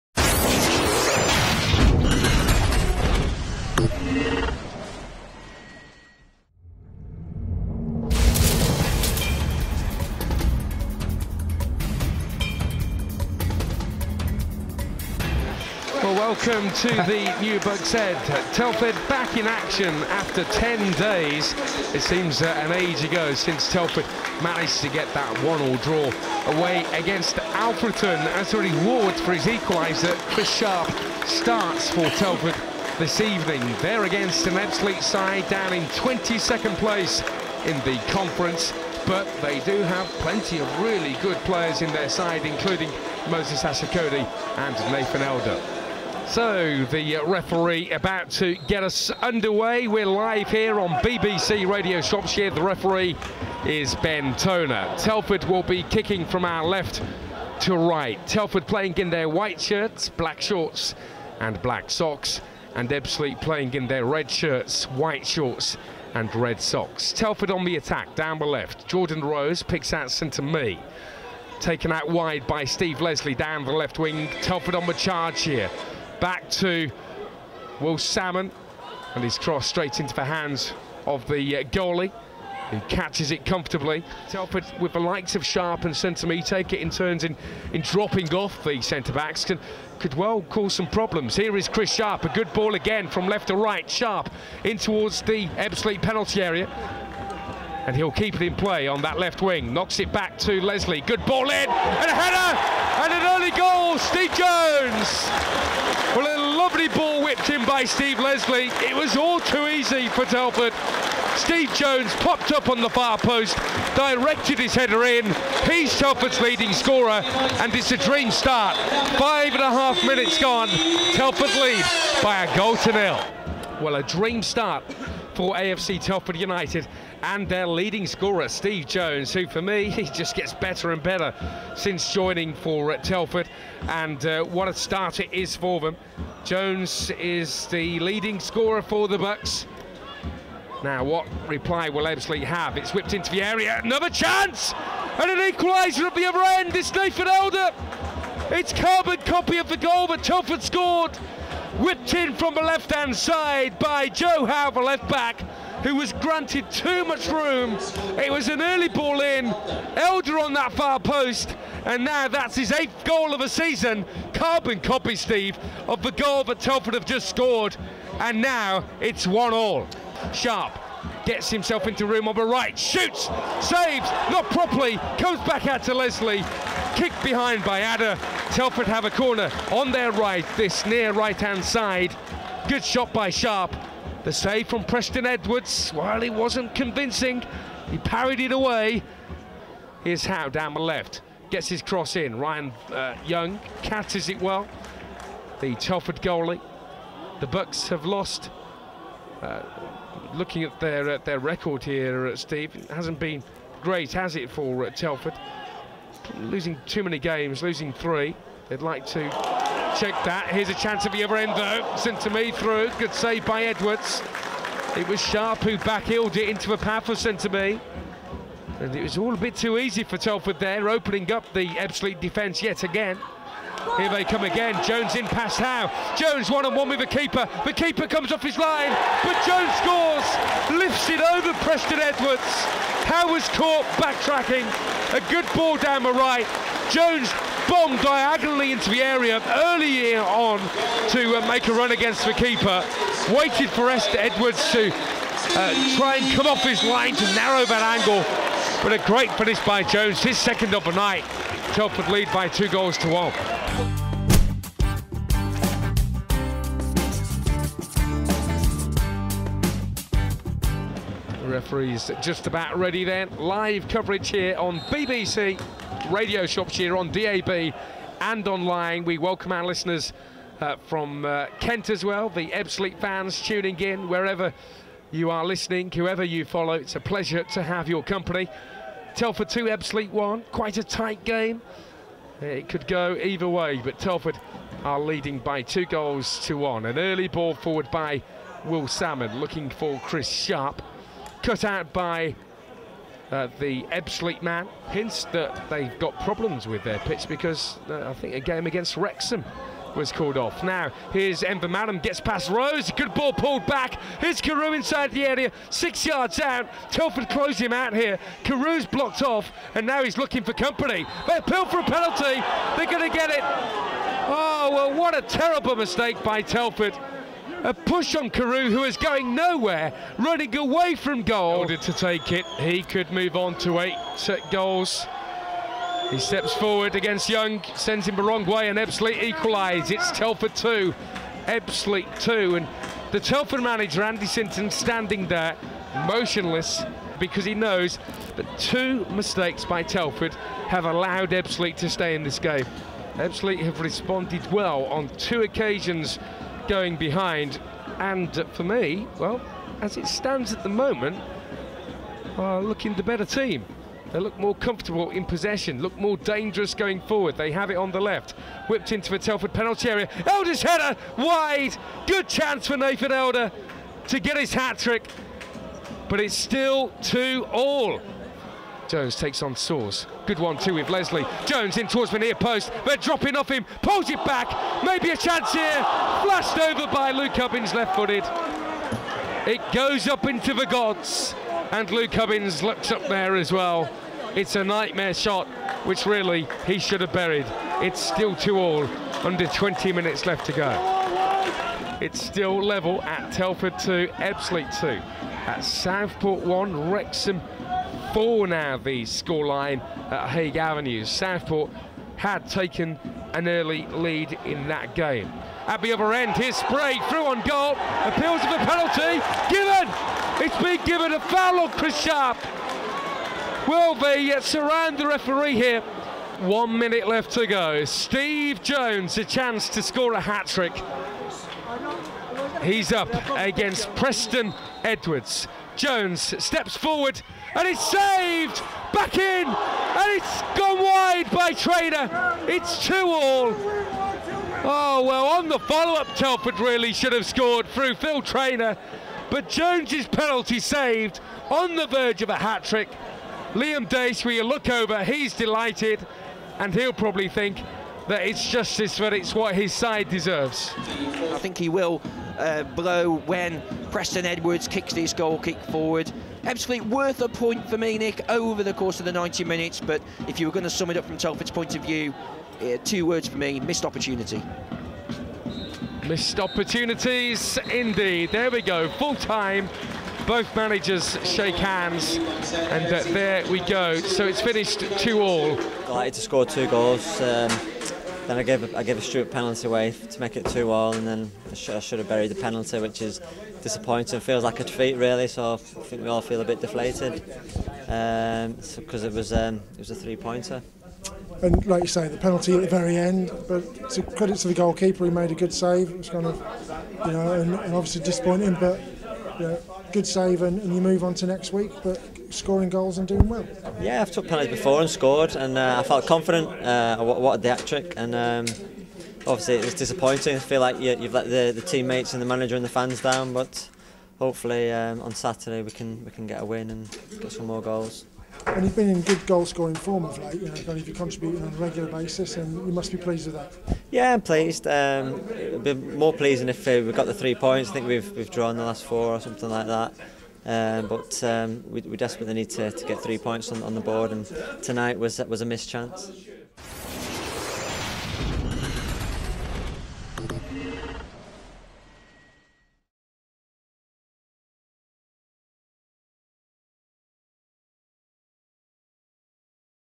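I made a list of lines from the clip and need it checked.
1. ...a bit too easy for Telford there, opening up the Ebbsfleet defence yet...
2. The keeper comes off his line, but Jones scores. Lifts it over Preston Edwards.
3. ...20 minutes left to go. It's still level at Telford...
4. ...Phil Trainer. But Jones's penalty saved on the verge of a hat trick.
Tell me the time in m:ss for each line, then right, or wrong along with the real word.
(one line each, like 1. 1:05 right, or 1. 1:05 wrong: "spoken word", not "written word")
1. 3:39 right
2. 3:47 right
3. 6:29 right
4. 7:17 right.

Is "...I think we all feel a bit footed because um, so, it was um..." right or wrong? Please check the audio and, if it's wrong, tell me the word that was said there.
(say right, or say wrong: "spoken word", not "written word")
wrong: "deflated", not "footed".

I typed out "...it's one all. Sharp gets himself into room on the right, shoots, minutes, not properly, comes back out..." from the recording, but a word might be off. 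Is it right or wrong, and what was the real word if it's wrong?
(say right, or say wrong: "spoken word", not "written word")
wrong: "saves", not "minutes".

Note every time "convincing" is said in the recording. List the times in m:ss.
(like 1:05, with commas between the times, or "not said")
3:06.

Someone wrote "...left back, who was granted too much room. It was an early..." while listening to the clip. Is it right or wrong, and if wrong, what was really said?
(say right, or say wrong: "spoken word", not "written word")
right.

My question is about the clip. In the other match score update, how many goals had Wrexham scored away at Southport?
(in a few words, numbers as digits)
4.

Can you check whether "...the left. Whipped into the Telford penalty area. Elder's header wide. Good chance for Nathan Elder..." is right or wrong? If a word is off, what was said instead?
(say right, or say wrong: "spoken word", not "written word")
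right.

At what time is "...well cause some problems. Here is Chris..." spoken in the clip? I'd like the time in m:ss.
1:30.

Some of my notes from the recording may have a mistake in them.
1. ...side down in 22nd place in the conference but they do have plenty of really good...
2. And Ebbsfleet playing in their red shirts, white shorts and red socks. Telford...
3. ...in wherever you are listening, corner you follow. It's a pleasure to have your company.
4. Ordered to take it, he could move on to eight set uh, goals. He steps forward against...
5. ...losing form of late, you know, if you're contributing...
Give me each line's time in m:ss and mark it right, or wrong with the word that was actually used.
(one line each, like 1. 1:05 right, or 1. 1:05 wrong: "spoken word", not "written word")
1. 0:35 right
2. 1:02 right
3. 4:33 wrong: "whoever", not "corner"
4. 5:21 right
5. 8:39 wrong: "scoring", not "losing".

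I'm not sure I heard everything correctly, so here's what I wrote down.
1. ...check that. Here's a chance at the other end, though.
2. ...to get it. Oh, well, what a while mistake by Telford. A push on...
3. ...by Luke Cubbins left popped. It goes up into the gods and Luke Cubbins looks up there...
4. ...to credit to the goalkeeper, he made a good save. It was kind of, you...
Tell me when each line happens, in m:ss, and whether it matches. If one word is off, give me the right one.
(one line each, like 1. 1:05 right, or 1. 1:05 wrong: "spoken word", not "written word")
1. 3:29 right
2. 5:13 wrong: "terrible", not "while"
3. 6:16 wrong: "footed", not "popped"
4. 8:13 right.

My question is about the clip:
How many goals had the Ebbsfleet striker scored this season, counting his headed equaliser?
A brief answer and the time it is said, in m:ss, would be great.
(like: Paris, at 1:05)
8, at 2:42.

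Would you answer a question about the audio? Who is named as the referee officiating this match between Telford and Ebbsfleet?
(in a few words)
Ben Toner.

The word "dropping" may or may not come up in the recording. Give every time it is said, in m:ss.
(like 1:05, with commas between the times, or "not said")
1:27, 6:12.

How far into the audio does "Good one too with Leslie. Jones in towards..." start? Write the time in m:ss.
6:10.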